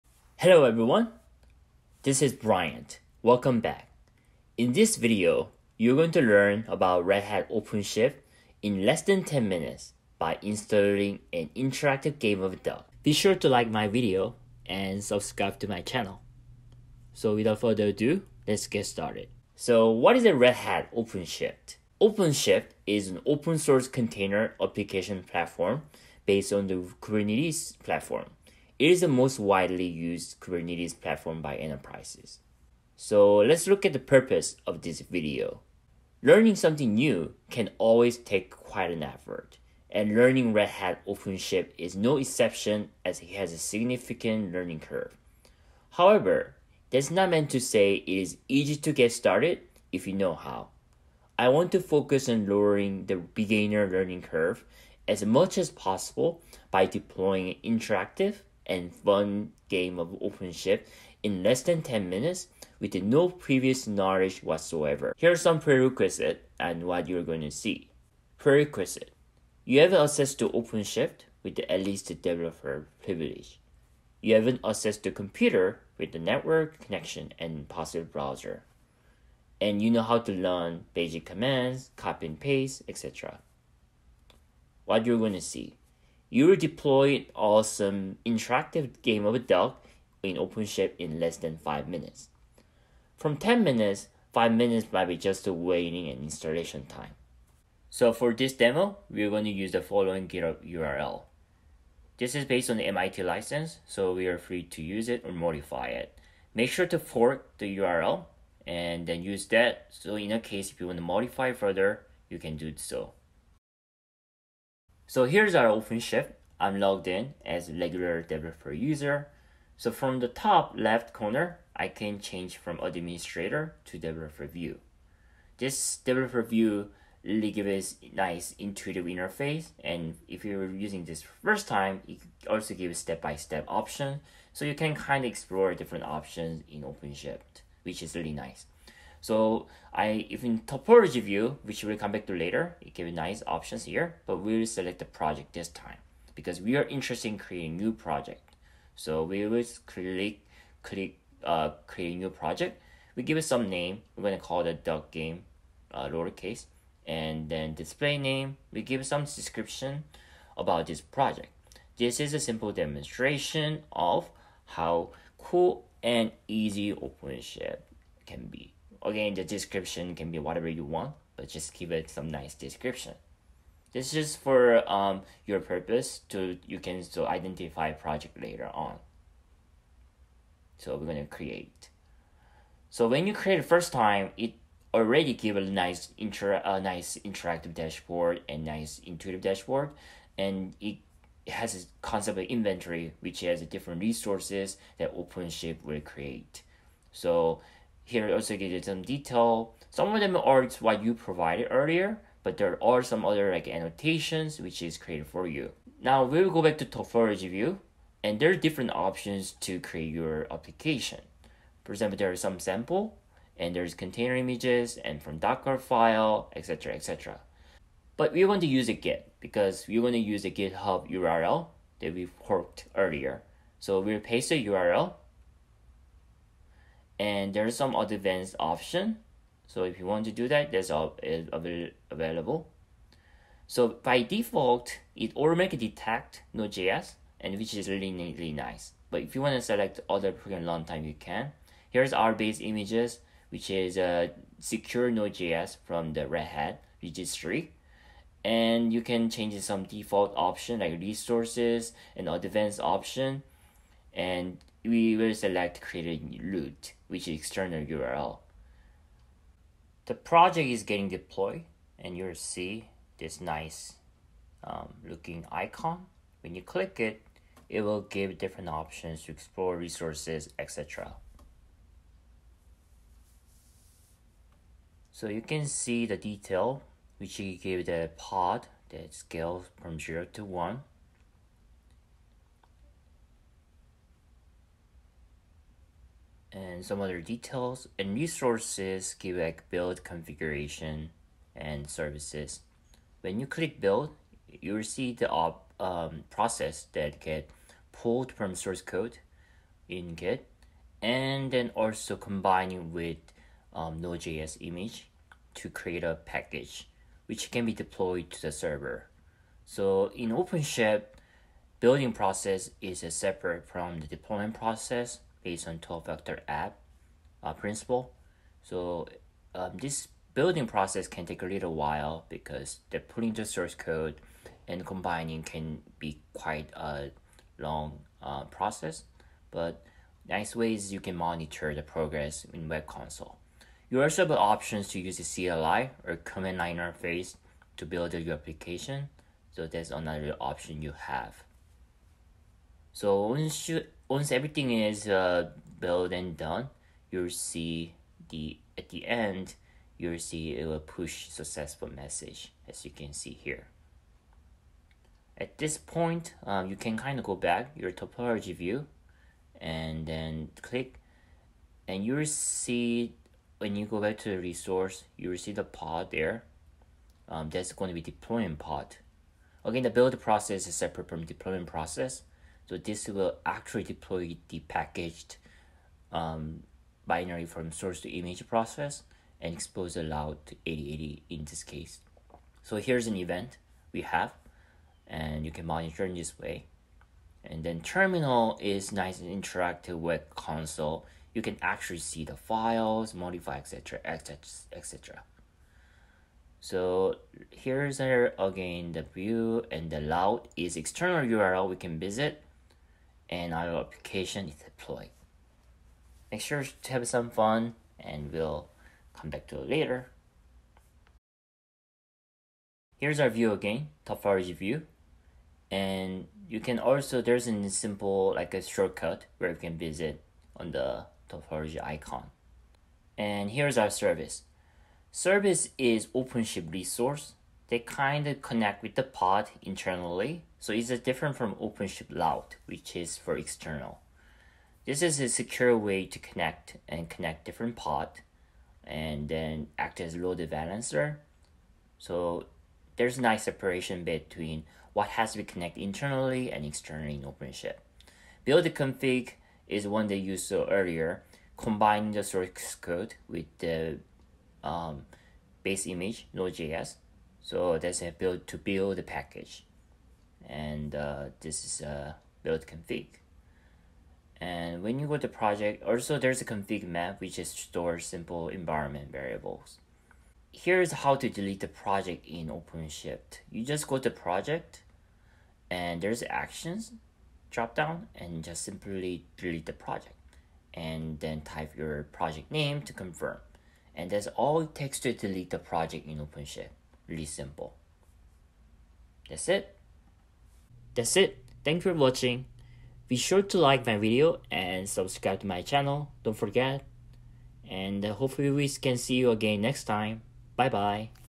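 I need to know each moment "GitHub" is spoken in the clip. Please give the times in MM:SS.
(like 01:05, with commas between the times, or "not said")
01:40, 03:40.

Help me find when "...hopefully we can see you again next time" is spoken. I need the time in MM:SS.
08:18.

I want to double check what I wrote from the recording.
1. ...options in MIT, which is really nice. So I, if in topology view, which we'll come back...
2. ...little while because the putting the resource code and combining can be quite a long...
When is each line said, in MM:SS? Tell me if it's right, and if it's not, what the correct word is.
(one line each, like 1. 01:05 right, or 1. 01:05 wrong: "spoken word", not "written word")
1. 02:16 wrong: "OpenShift", not "MIT"
2. 05:21 wrong: "source", not "resource".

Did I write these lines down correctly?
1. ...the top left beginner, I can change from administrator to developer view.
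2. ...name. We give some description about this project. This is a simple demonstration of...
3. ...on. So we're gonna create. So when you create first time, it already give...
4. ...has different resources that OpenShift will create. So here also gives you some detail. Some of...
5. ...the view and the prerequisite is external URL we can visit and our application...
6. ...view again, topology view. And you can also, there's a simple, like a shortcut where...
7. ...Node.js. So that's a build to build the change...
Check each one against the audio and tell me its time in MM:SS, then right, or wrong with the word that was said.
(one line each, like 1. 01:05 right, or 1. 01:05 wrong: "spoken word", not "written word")
1. 02:00 wrong: "corner", not "beginner"
2. 02:38 right
3. 02:58 right
4. 03:13 right
5. 06:38 wrong: "route", not "prerequisite"
6. 06:53 right
7. 07:36 wrong: "package", not "change".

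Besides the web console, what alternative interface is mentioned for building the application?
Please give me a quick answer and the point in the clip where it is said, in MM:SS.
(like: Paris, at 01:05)
command line interface, at 05:36.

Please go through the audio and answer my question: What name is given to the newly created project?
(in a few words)
duck game.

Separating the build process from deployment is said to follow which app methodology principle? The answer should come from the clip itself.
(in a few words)
12 factor app.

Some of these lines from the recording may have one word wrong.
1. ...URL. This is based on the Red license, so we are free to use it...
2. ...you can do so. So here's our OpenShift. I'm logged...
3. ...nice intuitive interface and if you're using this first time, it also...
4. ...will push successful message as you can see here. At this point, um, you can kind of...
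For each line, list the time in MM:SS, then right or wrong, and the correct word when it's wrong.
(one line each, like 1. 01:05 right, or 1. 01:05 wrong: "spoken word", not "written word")
1. 01:40 wrong: "MIT", not "Red"
2. 01:52 right
3. 02:08 right
4. 05:50 right.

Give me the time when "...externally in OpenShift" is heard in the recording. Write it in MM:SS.
07:26.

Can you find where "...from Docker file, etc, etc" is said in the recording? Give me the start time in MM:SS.
03:35.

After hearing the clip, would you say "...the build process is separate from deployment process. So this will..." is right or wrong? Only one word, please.
right.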